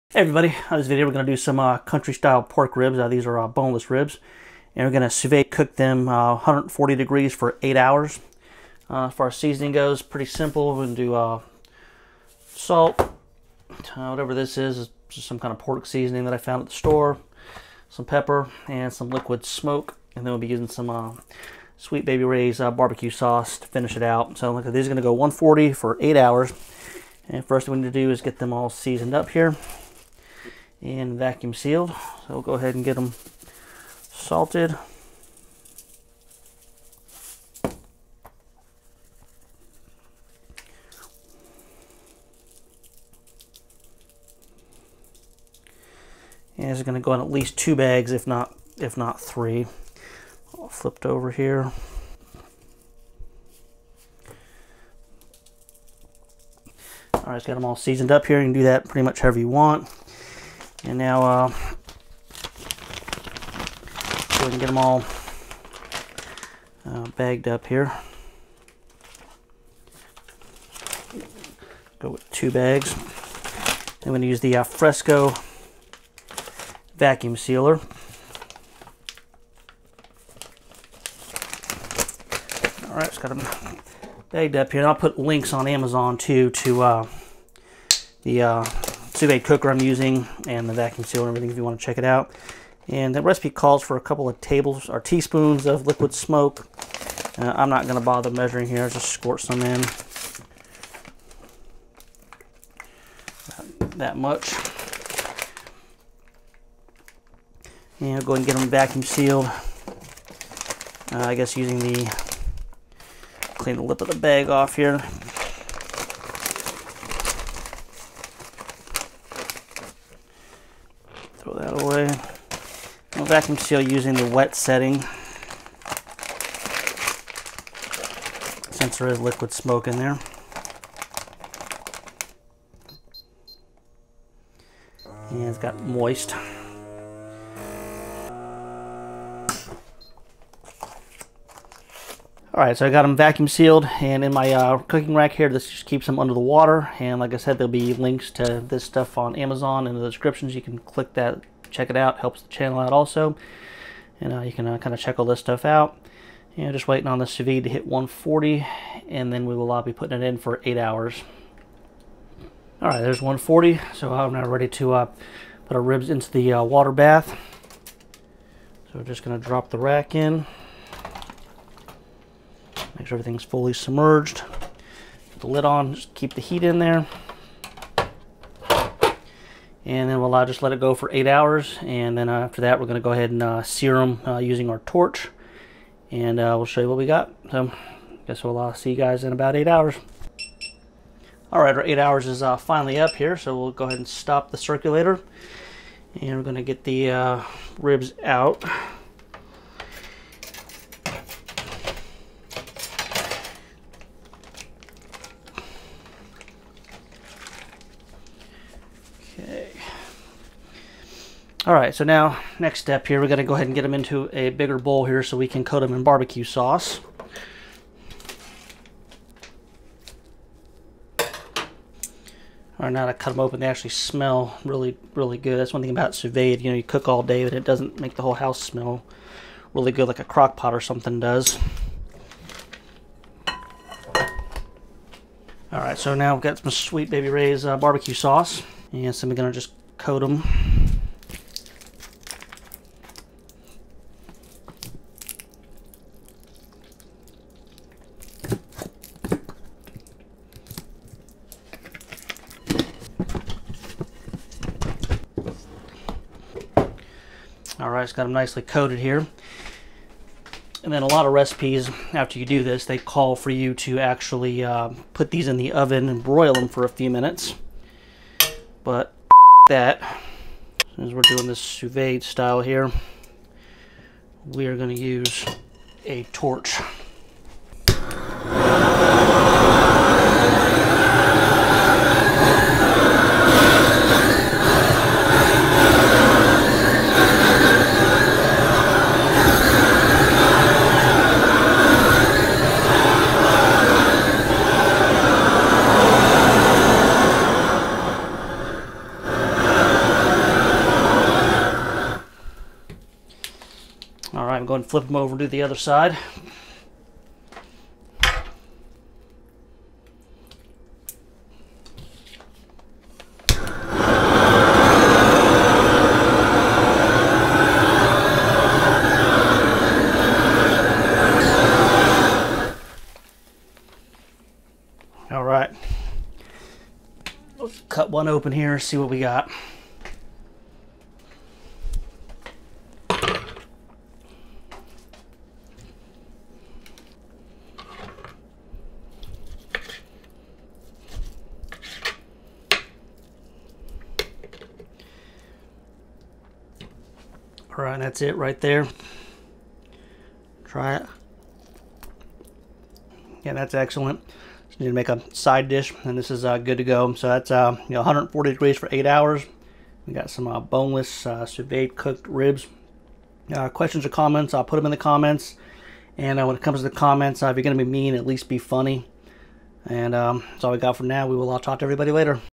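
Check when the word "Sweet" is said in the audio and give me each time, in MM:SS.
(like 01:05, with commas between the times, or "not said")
00:21, 03:56.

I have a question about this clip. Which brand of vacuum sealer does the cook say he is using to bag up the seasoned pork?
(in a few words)
Fresko.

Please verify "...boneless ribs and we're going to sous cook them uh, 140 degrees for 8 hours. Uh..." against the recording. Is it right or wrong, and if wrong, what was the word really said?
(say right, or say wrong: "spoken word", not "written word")
right.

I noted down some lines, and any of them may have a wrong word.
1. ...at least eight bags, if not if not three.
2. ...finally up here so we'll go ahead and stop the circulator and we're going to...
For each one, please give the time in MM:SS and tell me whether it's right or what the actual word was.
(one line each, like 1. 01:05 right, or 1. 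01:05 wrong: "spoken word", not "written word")
1. 00:47 wrong: "two", not "eight"
2. 03:12 right.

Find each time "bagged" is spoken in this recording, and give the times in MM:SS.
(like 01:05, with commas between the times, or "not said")
01:07, 01:24.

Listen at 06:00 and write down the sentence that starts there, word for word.
We got some uh, boneless uh, sous vide cooked ribs.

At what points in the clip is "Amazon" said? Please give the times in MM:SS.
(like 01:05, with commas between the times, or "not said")
01:25, 02:29.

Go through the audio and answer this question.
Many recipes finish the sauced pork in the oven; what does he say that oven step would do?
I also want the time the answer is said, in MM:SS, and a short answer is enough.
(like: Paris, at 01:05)
broil them, at 04:26.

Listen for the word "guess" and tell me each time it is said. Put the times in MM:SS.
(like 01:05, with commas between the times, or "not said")
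01:51, 03:08.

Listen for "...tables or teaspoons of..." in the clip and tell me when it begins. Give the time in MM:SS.
01:34.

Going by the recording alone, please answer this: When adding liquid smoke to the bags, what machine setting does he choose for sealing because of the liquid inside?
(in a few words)
wet setting.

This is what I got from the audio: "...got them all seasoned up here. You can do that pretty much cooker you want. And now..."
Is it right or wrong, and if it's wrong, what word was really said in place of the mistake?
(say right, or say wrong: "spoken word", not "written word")
wrong: "however", not "cooker".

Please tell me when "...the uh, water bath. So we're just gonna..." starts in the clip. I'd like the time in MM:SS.
02:46.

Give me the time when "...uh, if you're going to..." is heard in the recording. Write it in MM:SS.
06:07.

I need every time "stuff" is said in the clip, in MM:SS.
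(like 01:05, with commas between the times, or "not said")
02:28, 02:35.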